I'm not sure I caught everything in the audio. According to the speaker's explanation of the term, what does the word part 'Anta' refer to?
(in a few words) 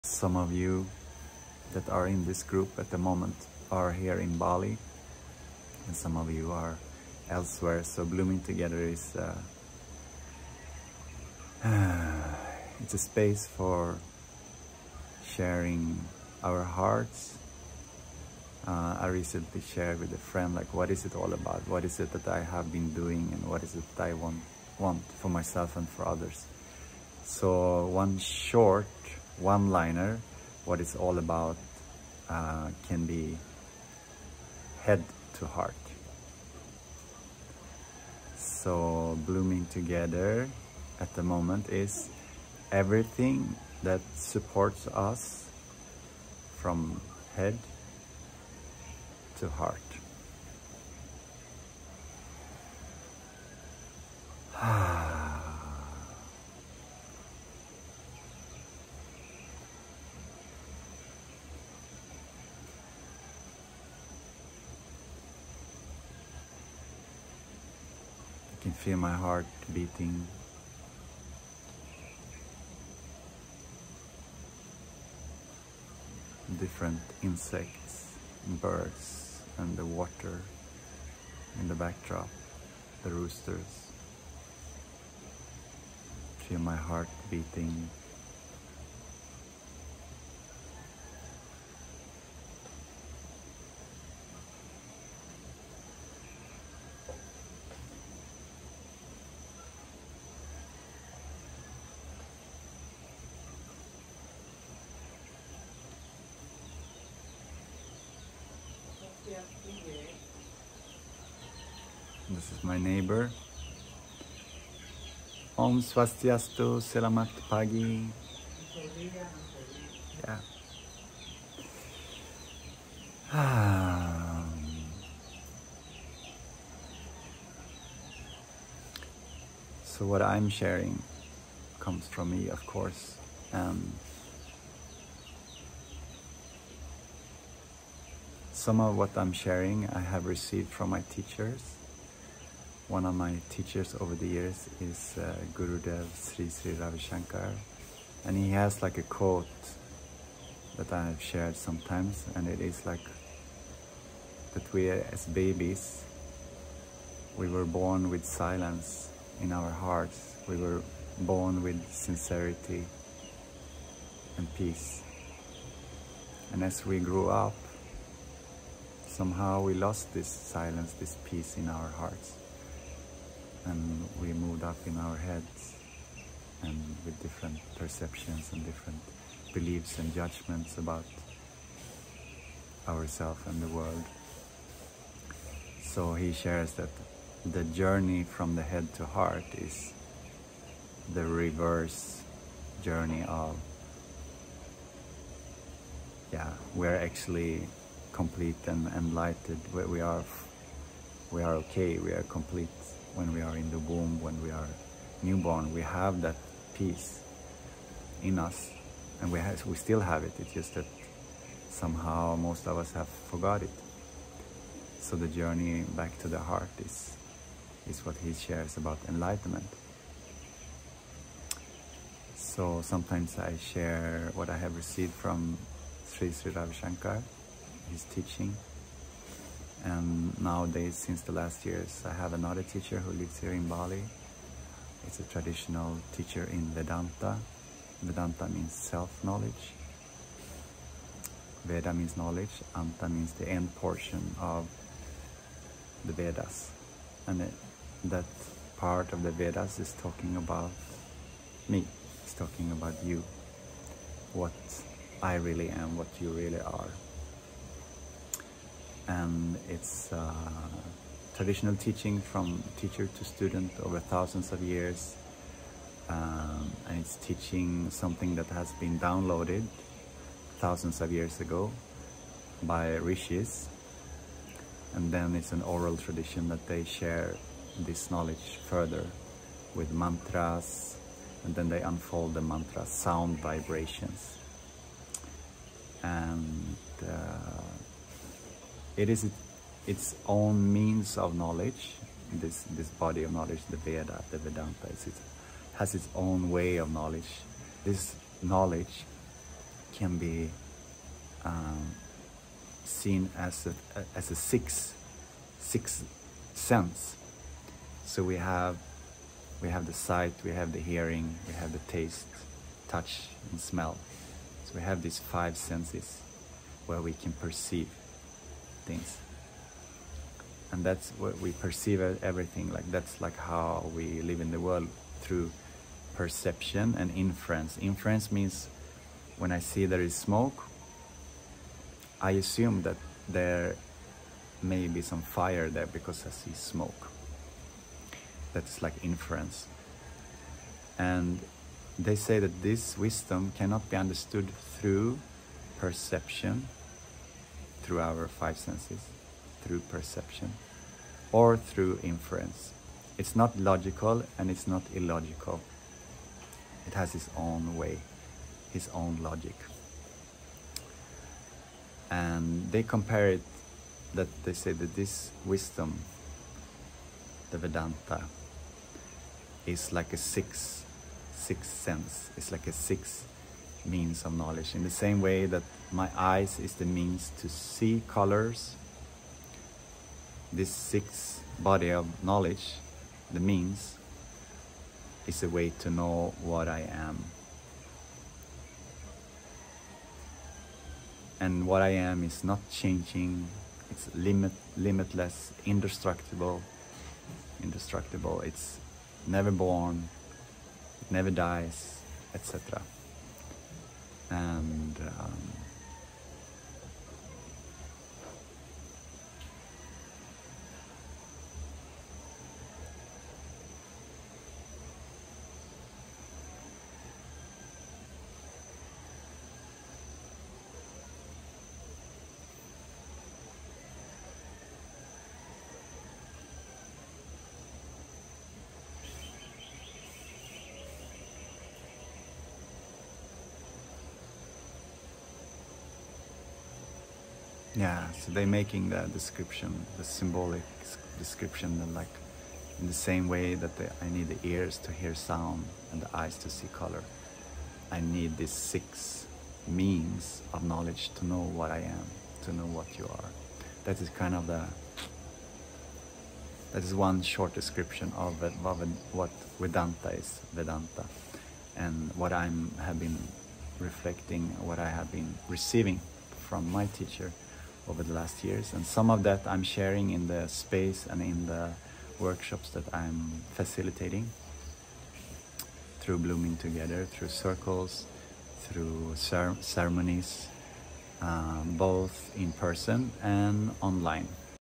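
End portion of the Vedas.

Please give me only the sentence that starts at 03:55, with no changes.
It's a traditional teacher in Vedanta.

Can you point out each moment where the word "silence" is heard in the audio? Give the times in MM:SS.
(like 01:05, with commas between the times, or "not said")
02:38, 02:50.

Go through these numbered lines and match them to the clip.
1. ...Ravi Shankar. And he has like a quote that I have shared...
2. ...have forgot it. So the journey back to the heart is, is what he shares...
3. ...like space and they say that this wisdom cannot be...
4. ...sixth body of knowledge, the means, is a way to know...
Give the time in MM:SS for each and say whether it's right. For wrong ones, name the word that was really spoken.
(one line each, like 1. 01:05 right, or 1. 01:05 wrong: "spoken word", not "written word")
1. 02:26 right
2. 03:32 right
3. 05:38 wrong: "inference", not "space"
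4. 06:20 right.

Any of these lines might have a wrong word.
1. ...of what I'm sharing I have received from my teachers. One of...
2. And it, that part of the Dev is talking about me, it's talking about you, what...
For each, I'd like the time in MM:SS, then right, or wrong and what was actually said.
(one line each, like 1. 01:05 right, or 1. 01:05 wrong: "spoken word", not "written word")
1. 02:18 right
2. 04:07 wrong: "Vedas", not "Dev".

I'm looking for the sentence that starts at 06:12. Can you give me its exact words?
It's like a sixth means of knowledge.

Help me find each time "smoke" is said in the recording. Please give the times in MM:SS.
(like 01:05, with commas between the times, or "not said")
05:30, 05:36.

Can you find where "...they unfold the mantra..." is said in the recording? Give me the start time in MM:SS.
04:41.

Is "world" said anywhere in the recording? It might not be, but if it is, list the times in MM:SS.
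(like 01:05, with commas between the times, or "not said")
03:03, 05:24.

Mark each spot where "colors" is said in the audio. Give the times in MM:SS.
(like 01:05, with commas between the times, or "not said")
06:18, 07:26.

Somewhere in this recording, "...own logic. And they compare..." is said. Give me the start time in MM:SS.
05:58.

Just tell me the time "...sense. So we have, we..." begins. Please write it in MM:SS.
05:06.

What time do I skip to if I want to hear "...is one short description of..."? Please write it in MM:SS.
07:36.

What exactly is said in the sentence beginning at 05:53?
It's not logical and it's not illogical.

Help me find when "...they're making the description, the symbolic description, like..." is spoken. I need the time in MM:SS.
07:18.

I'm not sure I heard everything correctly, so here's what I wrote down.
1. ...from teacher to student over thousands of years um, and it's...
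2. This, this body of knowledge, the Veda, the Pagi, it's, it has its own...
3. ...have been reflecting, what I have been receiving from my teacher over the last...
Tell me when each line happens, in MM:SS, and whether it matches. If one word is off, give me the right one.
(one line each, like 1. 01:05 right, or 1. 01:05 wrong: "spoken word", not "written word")
1. 04:22 right
2. 04:52 wrong: "Vedanta", not "Pagi"
3. 07:42 right.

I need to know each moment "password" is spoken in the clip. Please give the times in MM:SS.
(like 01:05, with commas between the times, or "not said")
not said.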